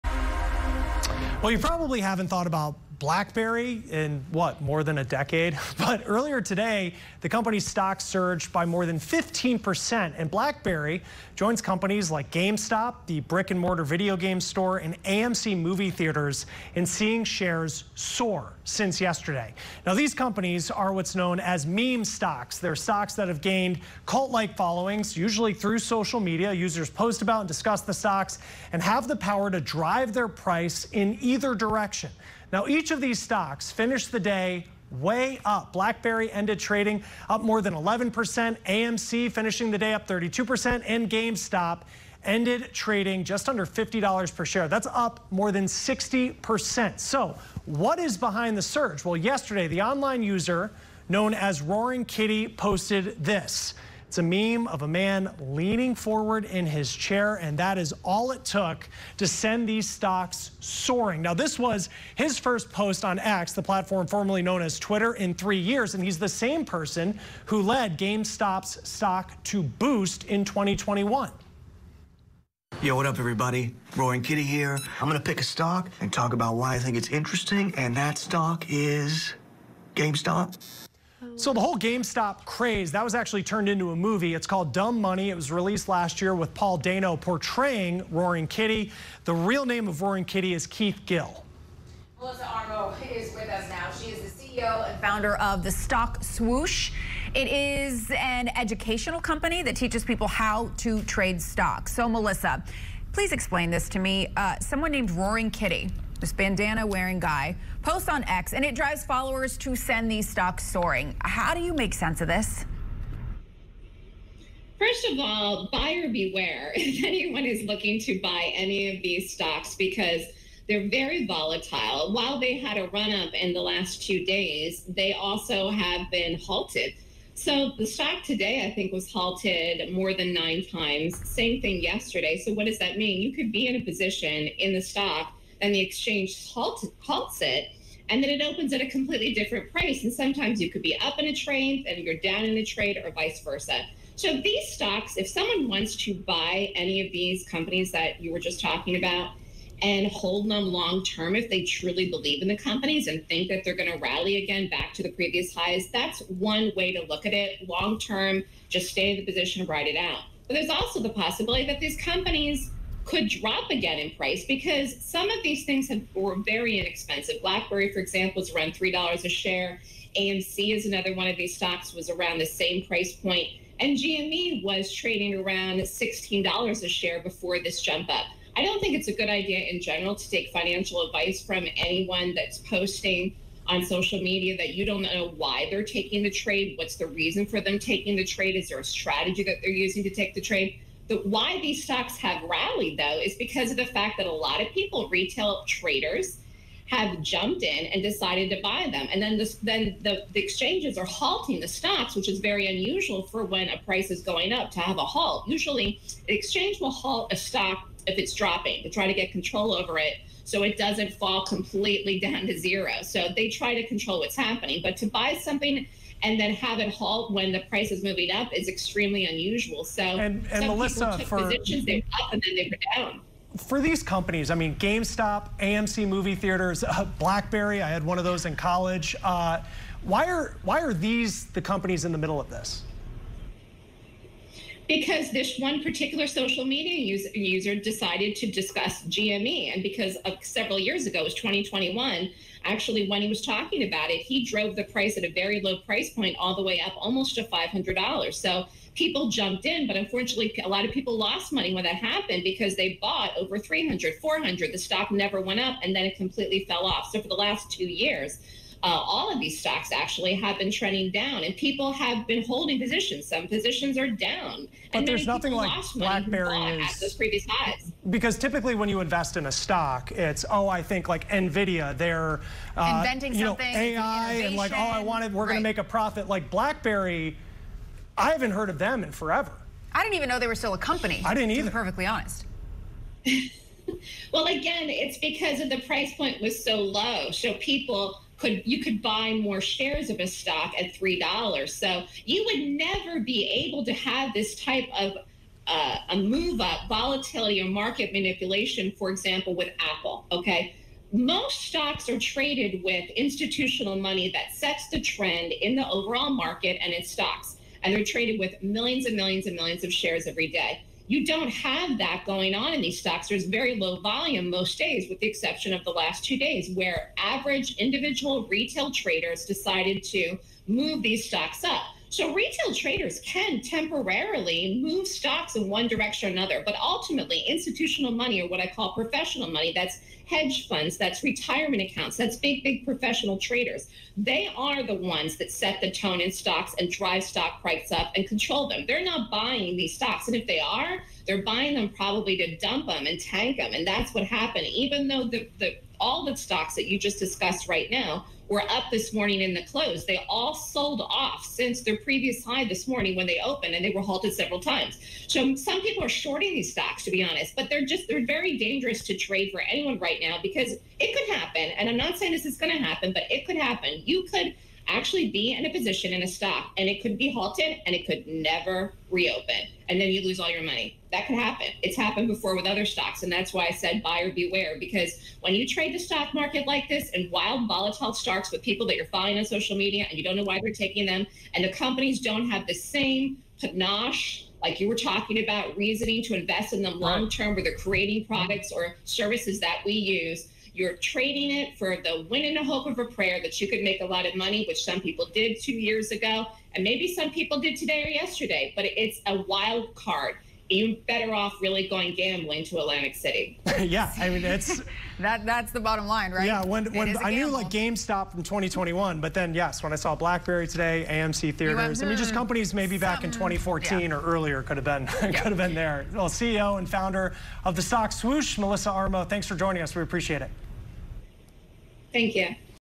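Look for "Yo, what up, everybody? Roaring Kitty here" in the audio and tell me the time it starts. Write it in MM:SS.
01:12.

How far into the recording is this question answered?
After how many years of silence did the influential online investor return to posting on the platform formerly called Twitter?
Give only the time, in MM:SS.
01:05.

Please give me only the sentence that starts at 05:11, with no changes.
You don't have that going on in these stocks.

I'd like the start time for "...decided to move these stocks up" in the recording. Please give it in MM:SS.
05:19.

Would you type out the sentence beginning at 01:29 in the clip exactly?
The real name of Roaring Kitty is Keith Gill.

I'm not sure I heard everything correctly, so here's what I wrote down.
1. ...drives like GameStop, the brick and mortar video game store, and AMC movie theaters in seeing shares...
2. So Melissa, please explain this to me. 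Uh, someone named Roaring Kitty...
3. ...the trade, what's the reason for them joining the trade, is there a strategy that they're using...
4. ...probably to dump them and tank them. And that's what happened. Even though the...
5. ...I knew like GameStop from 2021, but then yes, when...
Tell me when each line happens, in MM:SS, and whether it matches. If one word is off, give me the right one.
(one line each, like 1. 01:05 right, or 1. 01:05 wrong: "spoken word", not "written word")
1. 00:11 wrong: "companies", not "drives"
2. 01:41 right
3. 03:06 wrong: "taking", not "joining"
4. 05:41 right
5. 06:47 right.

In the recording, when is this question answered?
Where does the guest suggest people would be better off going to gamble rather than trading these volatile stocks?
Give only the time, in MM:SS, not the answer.
06:42.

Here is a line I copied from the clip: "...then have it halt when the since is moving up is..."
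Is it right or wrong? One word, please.
wrong.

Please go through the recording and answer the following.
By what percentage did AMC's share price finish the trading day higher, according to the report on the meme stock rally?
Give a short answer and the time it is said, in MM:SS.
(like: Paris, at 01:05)
32%, at 00:40.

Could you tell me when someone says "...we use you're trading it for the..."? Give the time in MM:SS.
06:29.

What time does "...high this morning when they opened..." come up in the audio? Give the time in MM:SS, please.
05:52.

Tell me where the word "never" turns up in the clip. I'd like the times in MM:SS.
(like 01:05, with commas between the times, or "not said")
04:15, 04:52, 06:08.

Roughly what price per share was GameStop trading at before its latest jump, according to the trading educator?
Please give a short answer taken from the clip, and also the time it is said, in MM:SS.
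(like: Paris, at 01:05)
$16, at 02:55.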